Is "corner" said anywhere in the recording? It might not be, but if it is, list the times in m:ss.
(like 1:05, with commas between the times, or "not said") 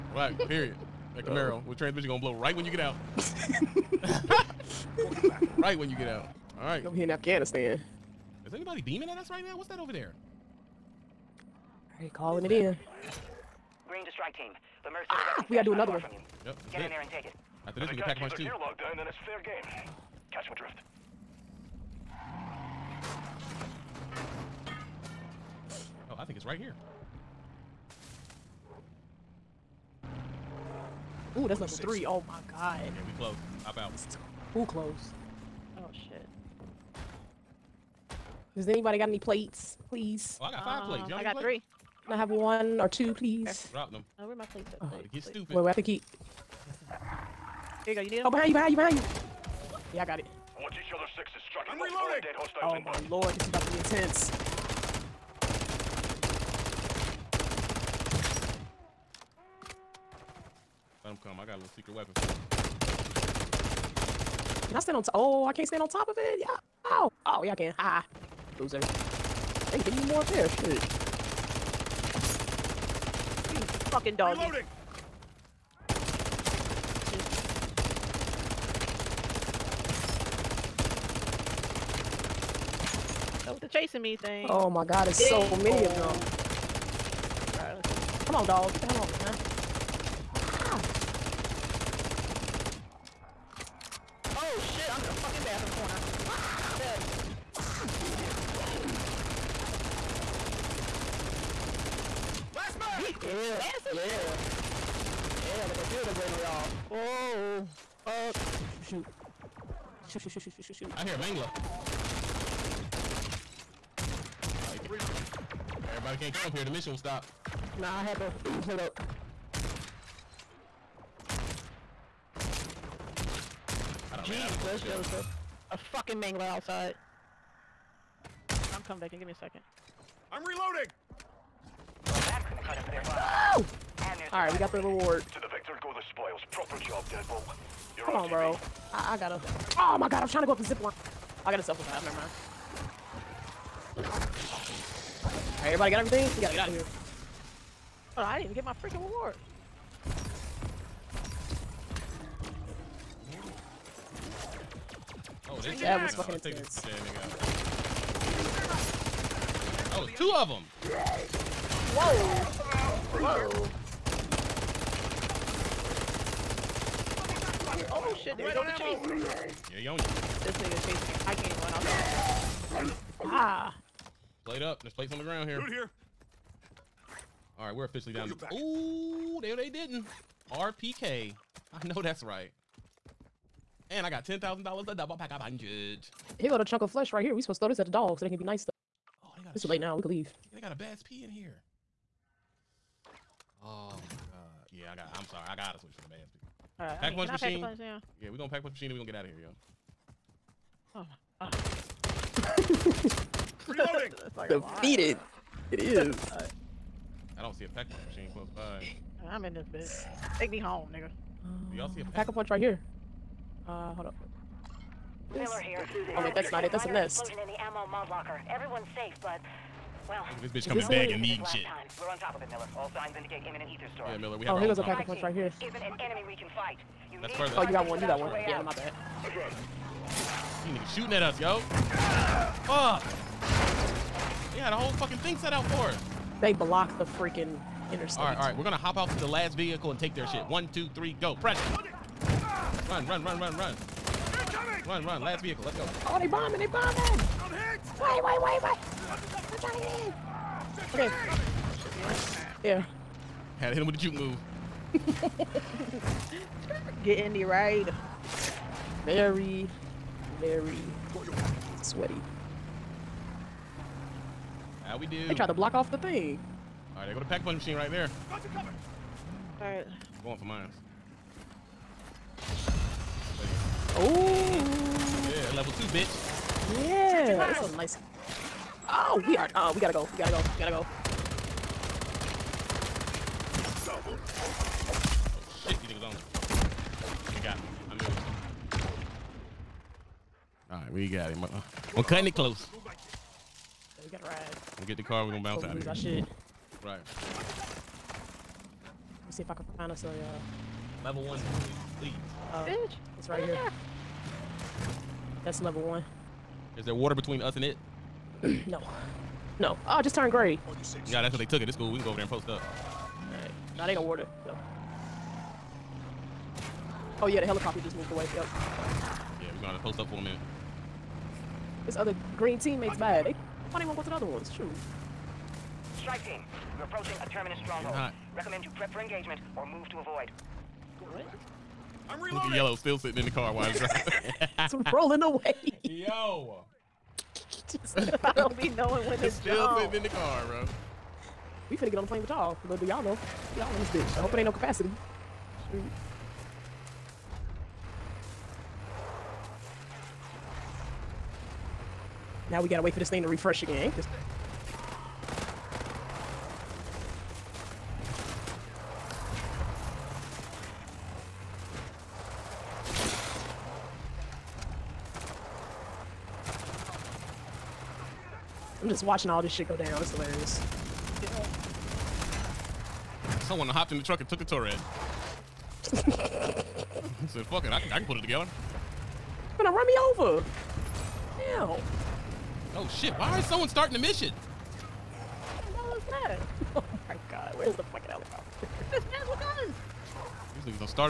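1:35.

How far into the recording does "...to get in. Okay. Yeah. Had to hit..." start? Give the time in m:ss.
4:09.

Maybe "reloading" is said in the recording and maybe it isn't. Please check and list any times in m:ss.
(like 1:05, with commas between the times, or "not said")
0:51, 1:14, 2:10, 3:23, 5:32.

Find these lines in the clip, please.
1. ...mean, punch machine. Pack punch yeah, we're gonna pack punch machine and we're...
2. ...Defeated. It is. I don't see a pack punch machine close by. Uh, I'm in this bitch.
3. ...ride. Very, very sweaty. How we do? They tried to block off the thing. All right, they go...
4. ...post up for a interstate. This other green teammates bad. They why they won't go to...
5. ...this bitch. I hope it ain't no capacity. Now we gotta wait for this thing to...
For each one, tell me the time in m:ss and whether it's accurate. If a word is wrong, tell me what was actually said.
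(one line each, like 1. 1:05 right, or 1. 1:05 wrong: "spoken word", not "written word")
1. 3:17 right
2. 3:24 right
3. 4:17 right
4. 5:19 wrong: "minute", not "interstate"
5. 5:43 right.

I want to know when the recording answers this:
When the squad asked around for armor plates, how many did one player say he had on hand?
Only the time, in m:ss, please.
0:40.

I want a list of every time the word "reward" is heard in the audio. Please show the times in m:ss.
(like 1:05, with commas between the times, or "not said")
2:14, 2:29.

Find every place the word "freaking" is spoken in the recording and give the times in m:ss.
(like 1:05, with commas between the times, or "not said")
2:28, 3:57.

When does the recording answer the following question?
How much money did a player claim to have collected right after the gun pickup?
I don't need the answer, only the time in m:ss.
3:04.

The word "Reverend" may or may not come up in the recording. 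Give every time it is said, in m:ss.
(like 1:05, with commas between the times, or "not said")
not said.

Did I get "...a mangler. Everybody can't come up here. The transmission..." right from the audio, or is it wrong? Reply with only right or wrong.
wrong.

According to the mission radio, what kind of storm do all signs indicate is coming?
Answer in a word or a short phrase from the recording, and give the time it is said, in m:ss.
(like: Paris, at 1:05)
Aether storm, at 3:43.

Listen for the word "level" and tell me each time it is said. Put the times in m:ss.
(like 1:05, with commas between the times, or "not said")
4:35, 5:01, 5:05.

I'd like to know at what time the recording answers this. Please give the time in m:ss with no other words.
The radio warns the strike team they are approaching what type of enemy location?
5:27.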